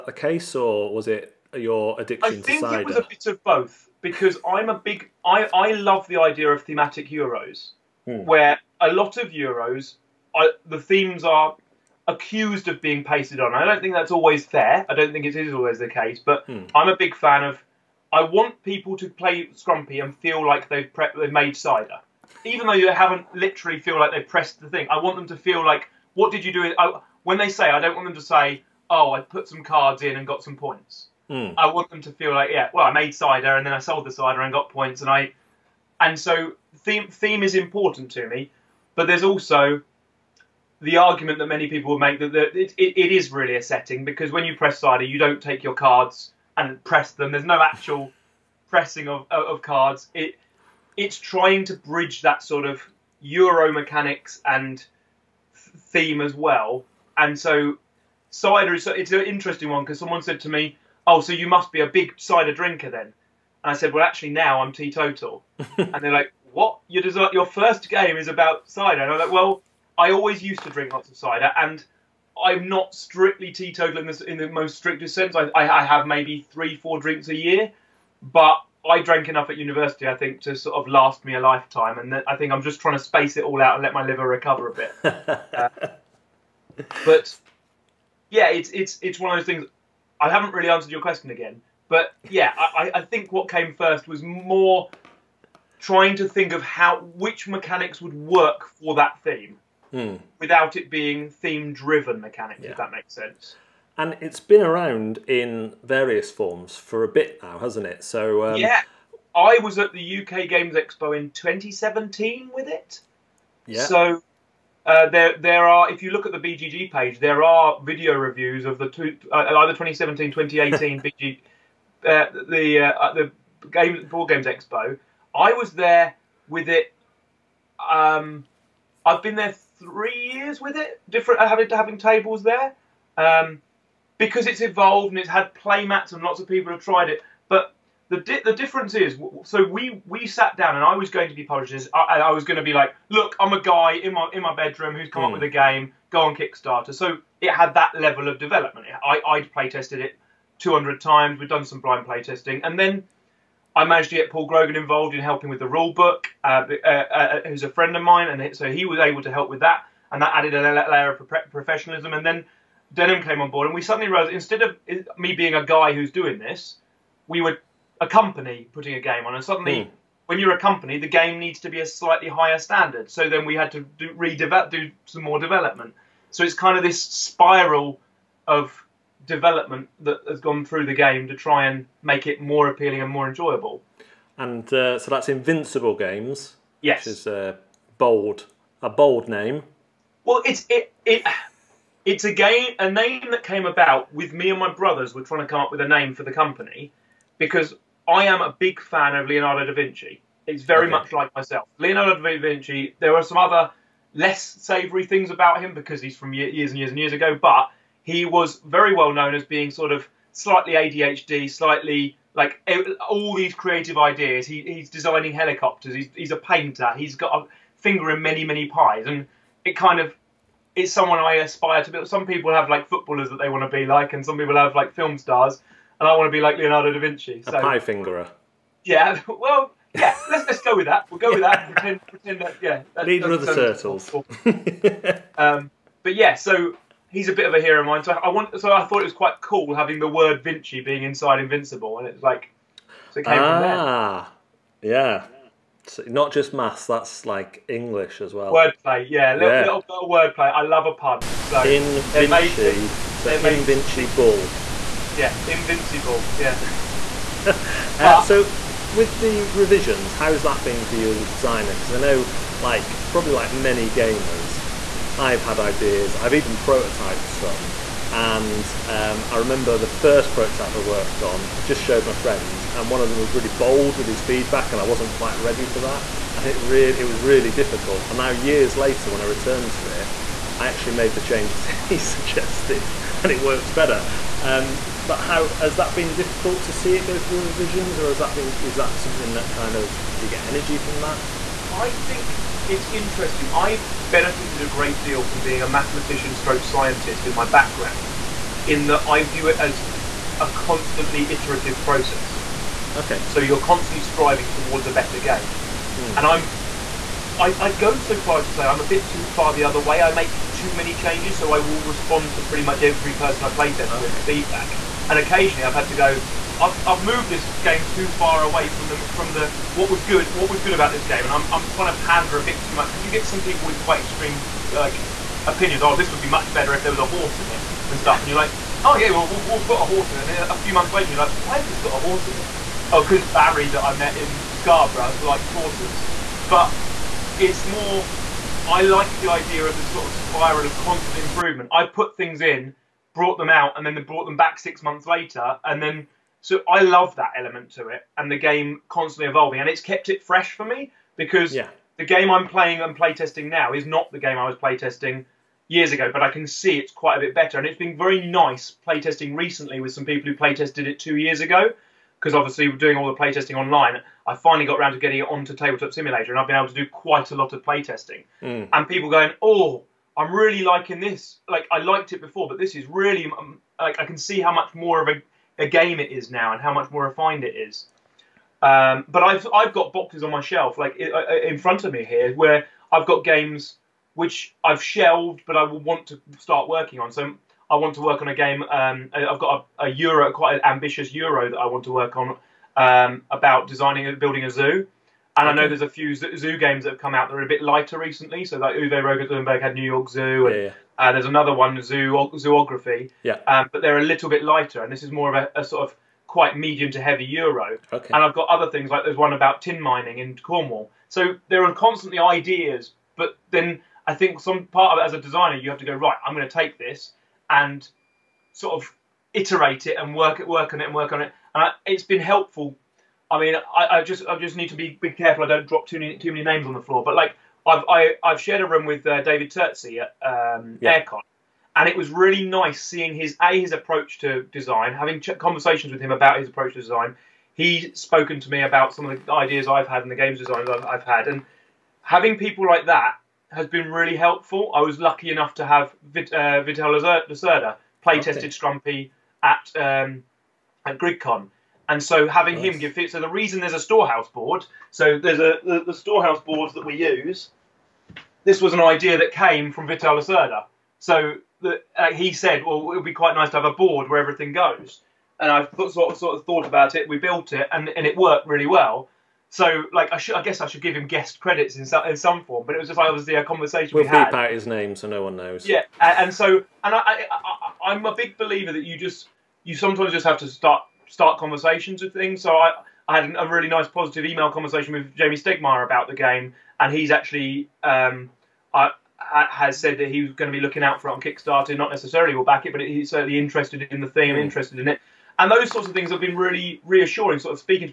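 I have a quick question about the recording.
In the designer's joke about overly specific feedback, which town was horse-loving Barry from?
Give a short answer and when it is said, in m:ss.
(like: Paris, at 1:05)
Scarborough, at 5:34.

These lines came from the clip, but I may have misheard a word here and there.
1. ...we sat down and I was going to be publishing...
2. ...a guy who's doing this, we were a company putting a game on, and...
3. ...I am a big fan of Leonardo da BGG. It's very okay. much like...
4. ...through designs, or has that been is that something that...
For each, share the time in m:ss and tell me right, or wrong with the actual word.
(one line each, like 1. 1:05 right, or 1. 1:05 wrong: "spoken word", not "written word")
1. 2:20 right
2. 2:45 right
3. 3:18 wrong: "Vinci", not "BGG"
4. 4:47 wrong: "revisions", not "designs".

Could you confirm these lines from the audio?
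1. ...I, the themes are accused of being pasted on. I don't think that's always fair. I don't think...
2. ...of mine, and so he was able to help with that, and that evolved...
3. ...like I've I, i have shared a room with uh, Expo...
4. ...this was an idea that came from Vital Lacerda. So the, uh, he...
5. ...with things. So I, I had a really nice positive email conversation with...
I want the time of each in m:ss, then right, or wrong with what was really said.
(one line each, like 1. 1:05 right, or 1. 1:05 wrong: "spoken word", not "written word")
1. 0:10 right
2. 2:37 wrong: "added", not "evolved"
3. 7:07 wrong: "David", not "Expo"
4. 7:38 right
5. 8:02 right.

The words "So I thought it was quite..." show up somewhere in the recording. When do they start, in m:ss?
3:58.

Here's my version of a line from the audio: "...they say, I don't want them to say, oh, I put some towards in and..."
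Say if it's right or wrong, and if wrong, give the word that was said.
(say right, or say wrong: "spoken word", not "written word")
wrong: "cards", not "towards".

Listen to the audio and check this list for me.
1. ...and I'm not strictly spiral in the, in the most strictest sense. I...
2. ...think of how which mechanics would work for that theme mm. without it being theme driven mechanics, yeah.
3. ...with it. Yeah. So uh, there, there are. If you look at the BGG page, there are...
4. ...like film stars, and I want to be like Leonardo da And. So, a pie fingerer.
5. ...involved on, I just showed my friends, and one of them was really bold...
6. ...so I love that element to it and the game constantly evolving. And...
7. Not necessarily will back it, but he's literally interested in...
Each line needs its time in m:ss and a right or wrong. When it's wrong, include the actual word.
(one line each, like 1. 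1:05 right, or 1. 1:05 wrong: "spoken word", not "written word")
1. 1:11 wrong: "teetotal", not "spiral"
2. 1:36 right
3. 1:52 right
4. 3:44 wrong: "Vinci", not "And"
5. 4:30 wrong: "worked", not "involved"
6. 5:46 right
7. 8:11 wrong: "certainly", not "literally".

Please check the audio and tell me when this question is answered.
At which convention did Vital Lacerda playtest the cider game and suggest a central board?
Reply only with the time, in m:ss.
7:30.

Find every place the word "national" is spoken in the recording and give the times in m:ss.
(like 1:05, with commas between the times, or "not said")
not said.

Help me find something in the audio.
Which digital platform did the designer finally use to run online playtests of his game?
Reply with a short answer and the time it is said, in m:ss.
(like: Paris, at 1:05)
Tabletop Simulator, at 6:05.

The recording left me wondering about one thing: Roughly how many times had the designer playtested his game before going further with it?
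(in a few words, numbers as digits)
200.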